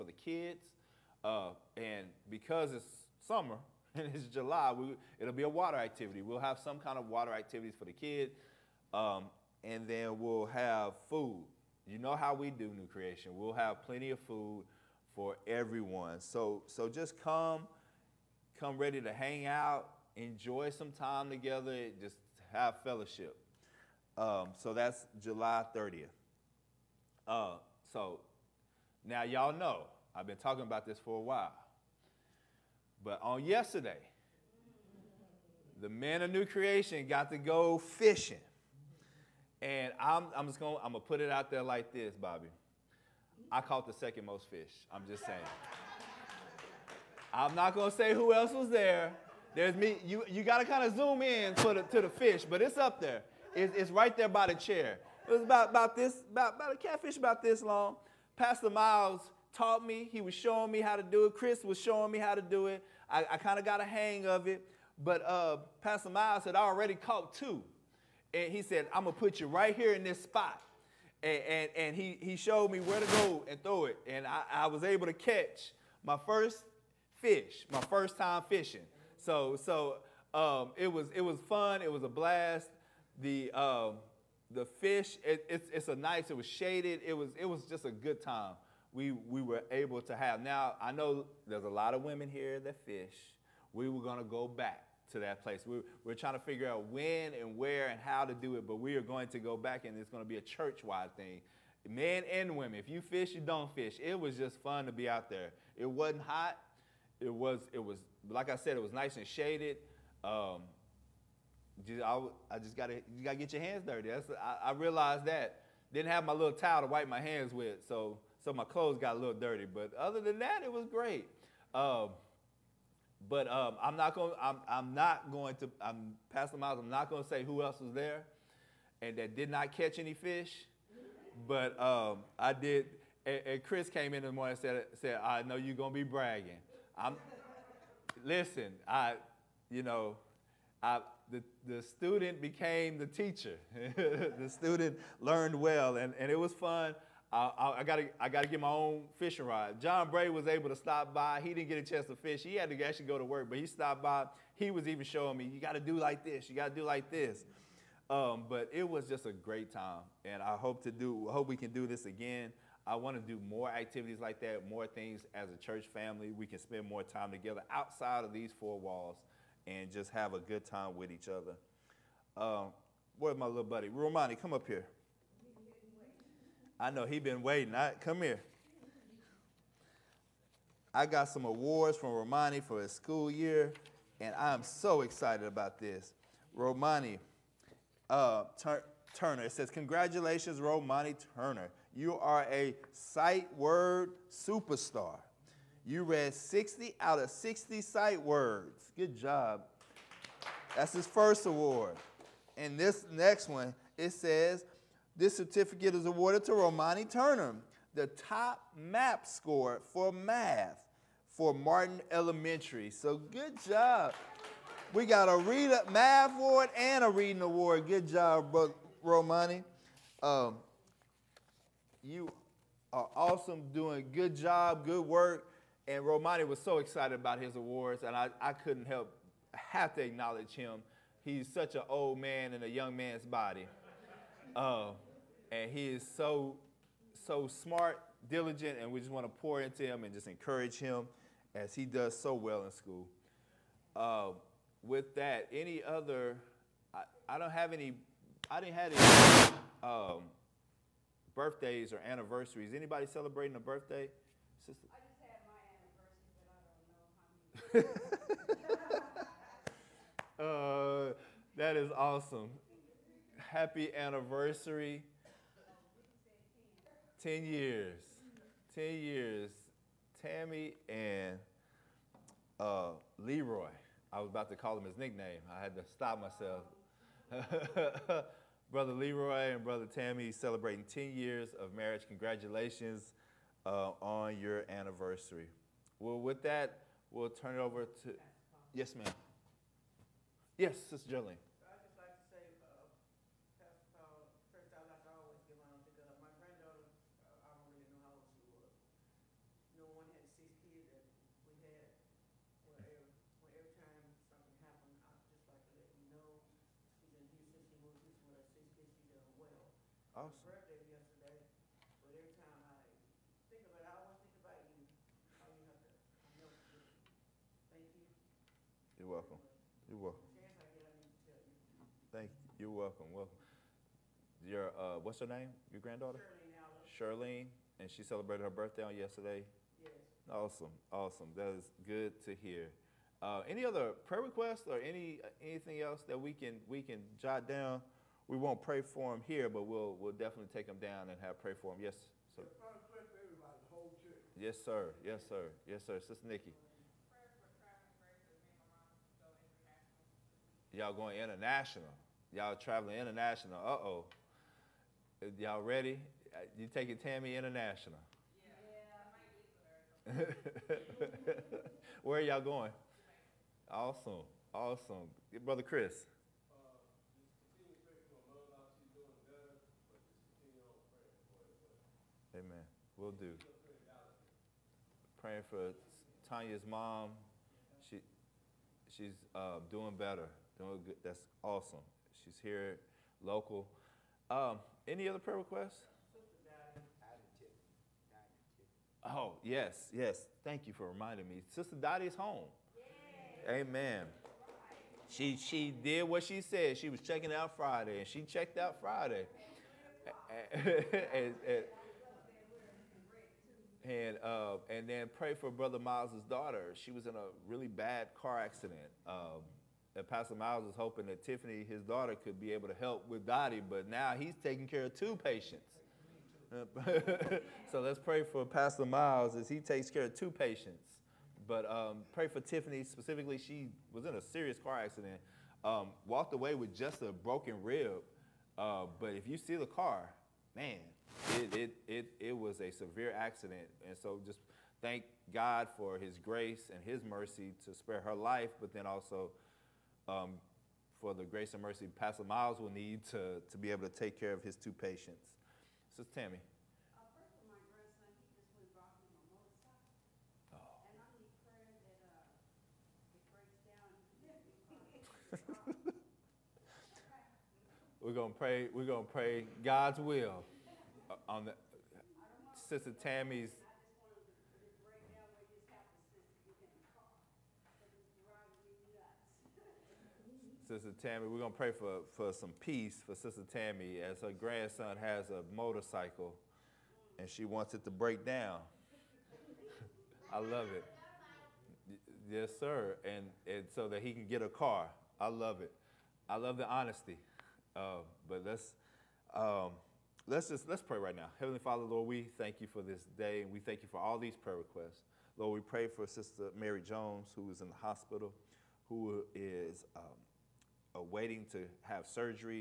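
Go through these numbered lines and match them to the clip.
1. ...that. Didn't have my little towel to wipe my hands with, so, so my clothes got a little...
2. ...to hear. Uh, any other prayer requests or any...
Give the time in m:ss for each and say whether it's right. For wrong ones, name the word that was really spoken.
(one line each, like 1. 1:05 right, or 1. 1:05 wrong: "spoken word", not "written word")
1. 1:55 right
2. 5:32 right.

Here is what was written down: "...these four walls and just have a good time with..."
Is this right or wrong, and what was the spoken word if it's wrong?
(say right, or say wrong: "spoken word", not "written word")
right.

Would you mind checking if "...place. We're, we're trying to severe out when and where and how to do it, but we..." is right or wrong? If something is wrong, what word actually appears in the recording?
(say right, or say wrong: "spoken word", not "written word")
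wrong: "figure", not "severe".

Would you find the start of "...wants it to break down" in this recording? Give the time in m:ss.
7:57.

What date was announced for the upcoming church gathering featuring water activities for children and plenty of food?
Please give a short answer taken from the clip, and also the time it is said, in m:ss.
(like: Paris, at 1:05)
July 30th, at 0:25.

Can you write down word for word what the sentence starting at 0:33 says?
But on yesterday, the men of new creation got to go fishing.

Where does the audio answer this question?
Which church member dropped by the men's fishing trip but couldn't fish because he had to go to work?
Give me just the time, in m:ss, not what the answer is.
2:29.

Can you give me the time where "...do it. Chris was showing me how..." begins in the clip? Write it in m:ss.
1:01.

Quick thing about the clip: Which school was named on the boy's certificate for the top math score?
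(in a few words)
Martin Elementary.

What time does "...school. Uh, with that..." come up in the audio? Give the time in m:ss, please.
4:02.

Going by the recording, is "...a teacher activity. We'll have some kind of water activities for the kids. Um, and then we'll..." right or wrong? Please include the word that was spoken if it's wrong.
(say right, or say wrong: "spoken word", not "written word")
wrong: "water", not "teacher".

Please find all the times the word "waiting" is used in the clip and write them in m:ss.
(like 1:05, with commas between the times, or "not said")
2:57, 8:21.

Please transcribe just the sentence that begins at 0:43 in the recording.
I caught the second most fish.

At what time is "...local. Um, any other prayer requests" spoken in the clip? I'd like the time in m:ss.
6:23.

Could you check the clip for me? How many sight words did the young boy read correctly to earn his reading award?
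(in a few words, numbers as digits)
60.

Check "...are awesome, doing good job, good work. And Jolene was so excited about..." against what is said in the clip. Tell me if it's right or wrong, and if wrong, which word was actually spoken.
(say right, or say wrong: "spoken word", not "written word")
wrong: "Romani", not "Jolene".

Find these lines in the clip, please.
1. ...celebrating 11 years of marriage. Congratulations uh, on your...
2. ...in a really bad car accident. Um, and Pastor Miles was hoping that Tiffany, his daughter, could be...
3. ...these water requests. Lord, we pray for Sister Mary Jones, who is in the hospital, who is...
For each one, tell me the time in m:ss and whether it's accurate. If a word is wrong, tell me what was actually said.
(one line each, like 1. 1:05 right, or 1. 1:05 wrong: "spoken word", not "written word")
1. 4:40 wrong: "10", not "11"
2. 6:47 right
3. 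8:14 wrong: "prayer", not "water".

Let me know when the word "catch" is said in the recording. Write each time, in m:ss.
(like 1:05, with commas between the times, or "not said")
1:15, 2:09.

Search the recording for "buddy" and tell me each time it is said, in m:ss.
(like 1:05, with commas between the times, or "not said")
2:53.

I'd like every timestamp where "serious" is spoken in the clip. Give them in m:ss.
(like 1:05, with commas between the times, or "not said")
7:04.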